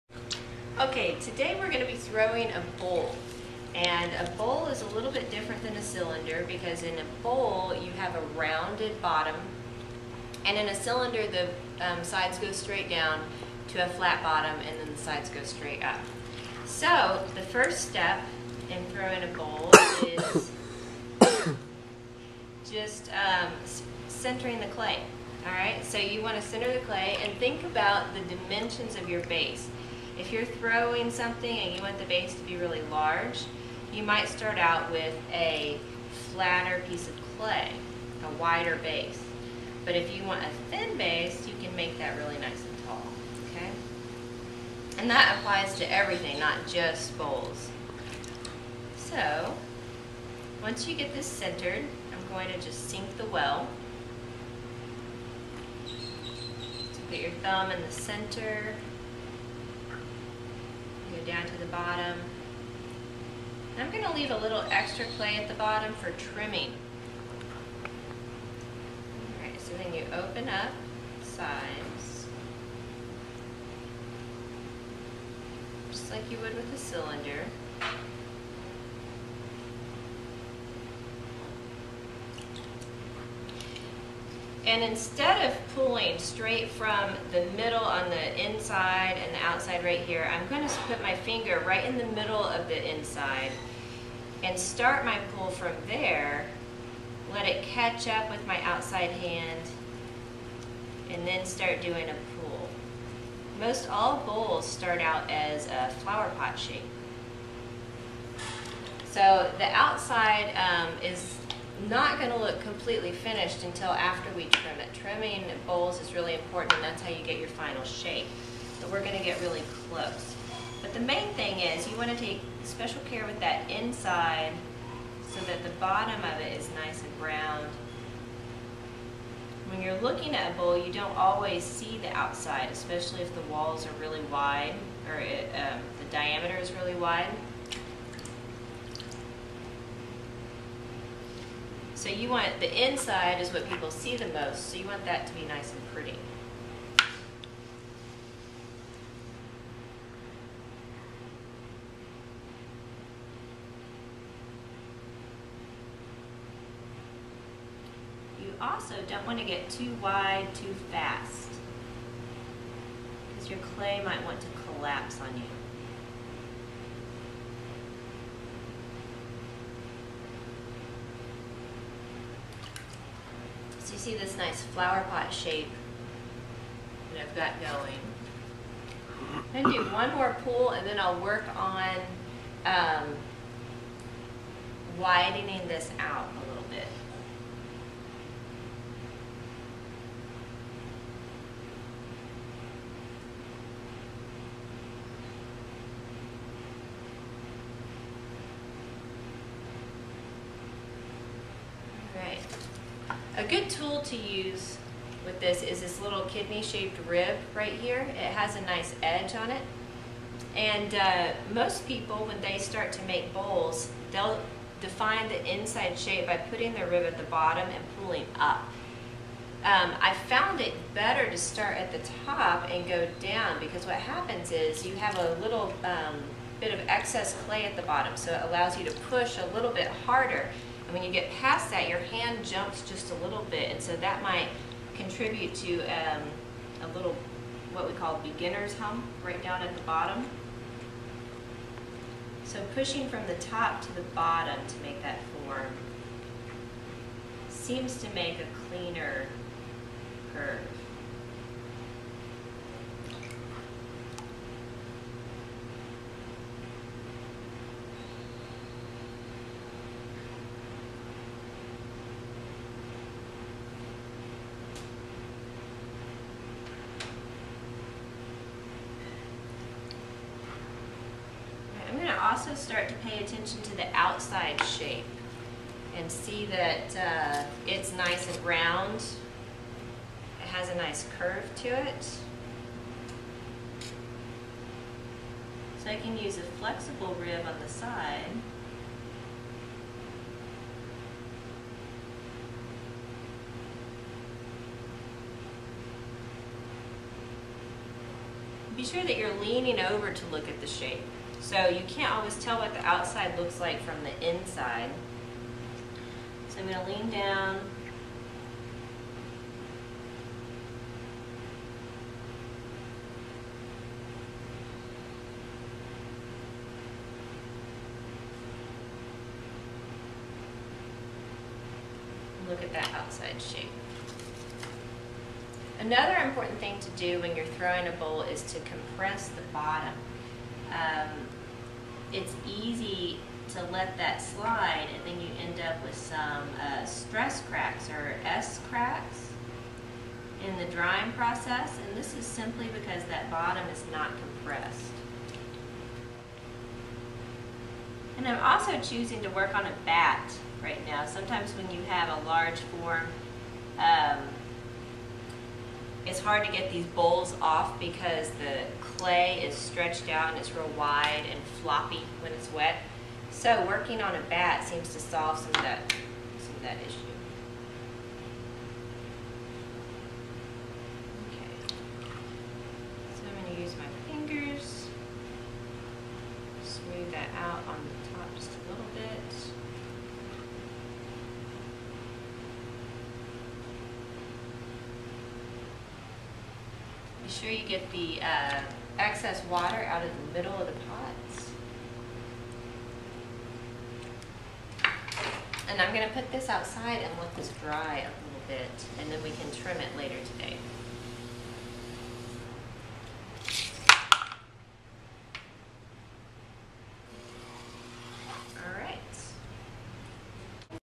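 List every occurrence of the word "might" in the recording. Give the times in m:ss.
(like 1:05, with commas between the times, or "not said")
0:34, 2:44, 3:54.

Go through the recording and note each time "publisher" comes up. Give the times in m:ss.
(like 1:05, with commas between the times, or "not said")
not said.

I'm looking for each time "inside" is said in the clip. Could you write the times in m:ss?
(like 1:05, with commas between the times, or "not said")
1:28, 1:32, 2:03, 2:22, 3:35, 5:04.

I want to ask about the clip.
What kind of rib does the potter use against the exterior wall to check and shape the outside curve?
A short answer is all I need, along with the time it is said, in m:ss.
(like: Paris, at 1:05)
flexible rib, at 4:46.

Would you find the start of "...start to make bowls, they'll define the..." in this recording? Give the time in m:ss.
3:32.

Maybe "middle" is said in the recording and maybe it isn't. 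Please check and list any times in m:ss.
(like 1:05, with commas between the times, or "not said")
1:27, 1:32, 6:30.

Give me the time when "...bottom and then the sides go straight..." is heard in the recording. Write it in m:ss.
0:14.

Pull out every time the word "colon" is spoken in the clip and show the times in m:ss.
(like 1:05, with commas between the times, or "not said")
not said.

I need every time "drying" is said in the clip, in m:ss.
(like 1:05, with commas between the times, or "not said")
5:40.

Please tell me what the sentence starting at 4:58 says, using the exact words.
Be sure that you're leaning over to look at the shape.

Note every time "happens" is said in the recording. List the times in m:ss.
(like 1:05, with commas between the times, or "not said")
3:43.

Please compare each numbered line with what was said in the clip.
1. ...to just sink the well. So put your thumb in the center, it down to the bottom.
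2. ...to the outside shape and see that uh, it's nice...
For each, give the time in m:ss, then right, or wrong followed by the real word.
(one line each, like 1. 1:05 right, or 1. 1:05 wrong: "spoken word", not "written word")
1. 0:52 right
2. 4:33 right.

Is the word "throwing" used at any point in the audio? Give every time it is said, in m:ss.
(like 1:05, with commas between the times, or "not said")
0:01, 0:18, 0:30, 5:27.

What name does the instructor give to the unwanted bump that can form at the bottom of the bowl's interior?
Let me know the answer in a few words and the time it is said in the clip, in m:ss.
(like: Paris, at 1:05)
beginner's hum, at 3:58.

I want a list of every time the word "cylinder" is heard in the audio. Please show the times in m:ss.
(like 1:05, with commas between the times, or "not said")
0:05, 0:10, 1:16.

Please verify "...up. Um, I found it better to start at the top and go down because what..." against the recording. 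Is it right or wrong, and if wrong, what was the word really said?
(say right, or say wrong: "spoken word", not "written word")
right.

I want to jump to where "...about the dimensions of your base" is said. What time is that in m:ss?
0:27.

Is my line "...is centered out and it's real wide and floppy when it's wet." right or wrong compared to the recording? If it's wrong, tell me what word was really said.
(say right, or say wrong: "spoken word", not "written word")
wrong: "stretched", not "centered".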